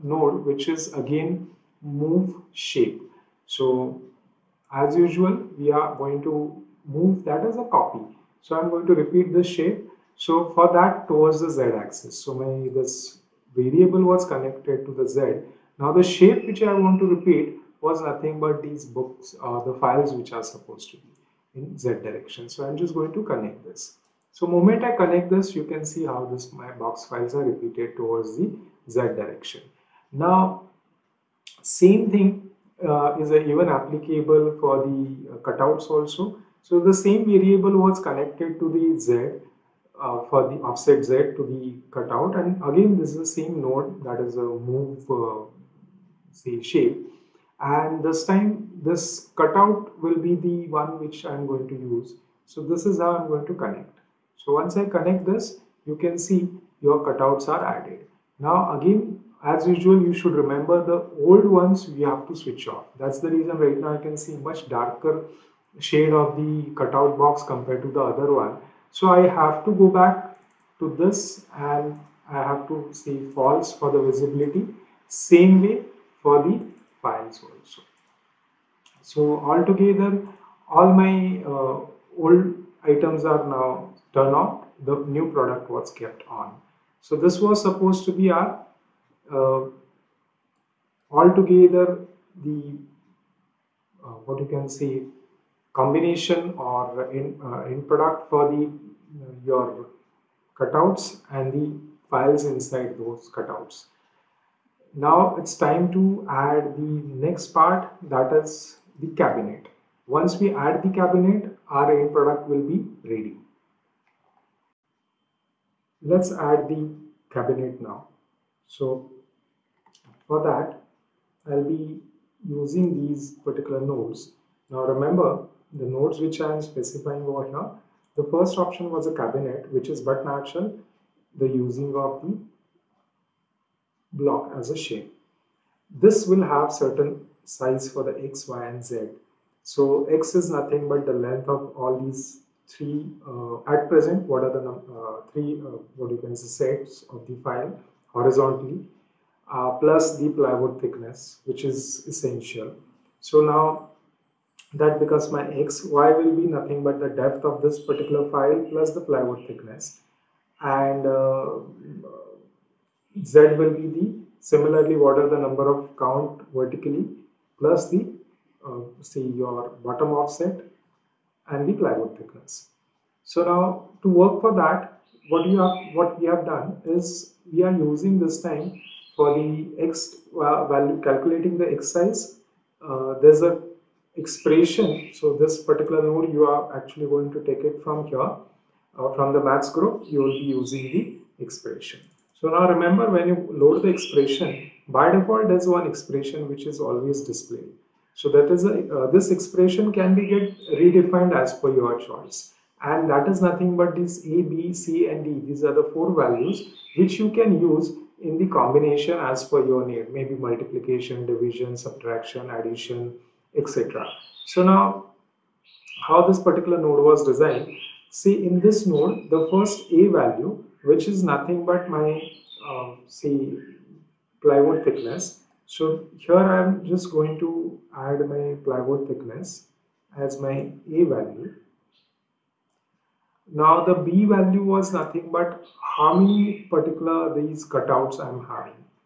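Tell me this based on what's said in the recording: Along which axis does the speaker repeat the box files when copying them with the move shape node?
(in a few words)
z axis.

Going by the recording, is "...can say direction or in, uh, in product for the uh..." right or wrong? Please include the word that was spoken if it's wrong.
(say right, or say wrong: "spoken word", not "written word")
wrong: "combination", not "direction".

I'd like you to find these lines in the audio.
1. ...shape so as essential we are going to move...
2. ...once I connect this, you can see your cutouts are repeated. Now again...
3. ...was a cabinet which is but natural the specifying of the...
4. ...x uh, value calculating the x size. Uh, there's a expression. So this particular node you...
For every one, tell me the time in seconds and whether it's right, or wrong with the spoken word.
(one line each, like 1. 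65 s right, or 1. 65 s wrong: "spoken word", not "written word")
1. 2 s wrong: "usual", not "essential"
2. 54 s wrong: "added", not "repeated"
3. 128 s wrong: "using", not "specifying"
4. 179 s right.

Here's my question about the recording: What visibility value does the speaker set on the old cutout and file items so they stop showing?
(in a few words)
false.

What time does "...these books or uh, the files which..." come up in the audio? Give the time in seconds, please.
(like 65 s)
18 s.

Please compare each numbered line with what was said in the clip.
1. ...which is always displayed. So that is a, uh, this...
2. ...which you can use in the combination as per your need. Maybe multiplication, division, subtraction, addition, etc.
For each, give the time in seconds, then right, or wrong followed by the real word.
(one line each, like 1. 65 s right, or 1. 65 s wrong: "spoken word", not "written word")
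1. 196 s right
2. 206 s right.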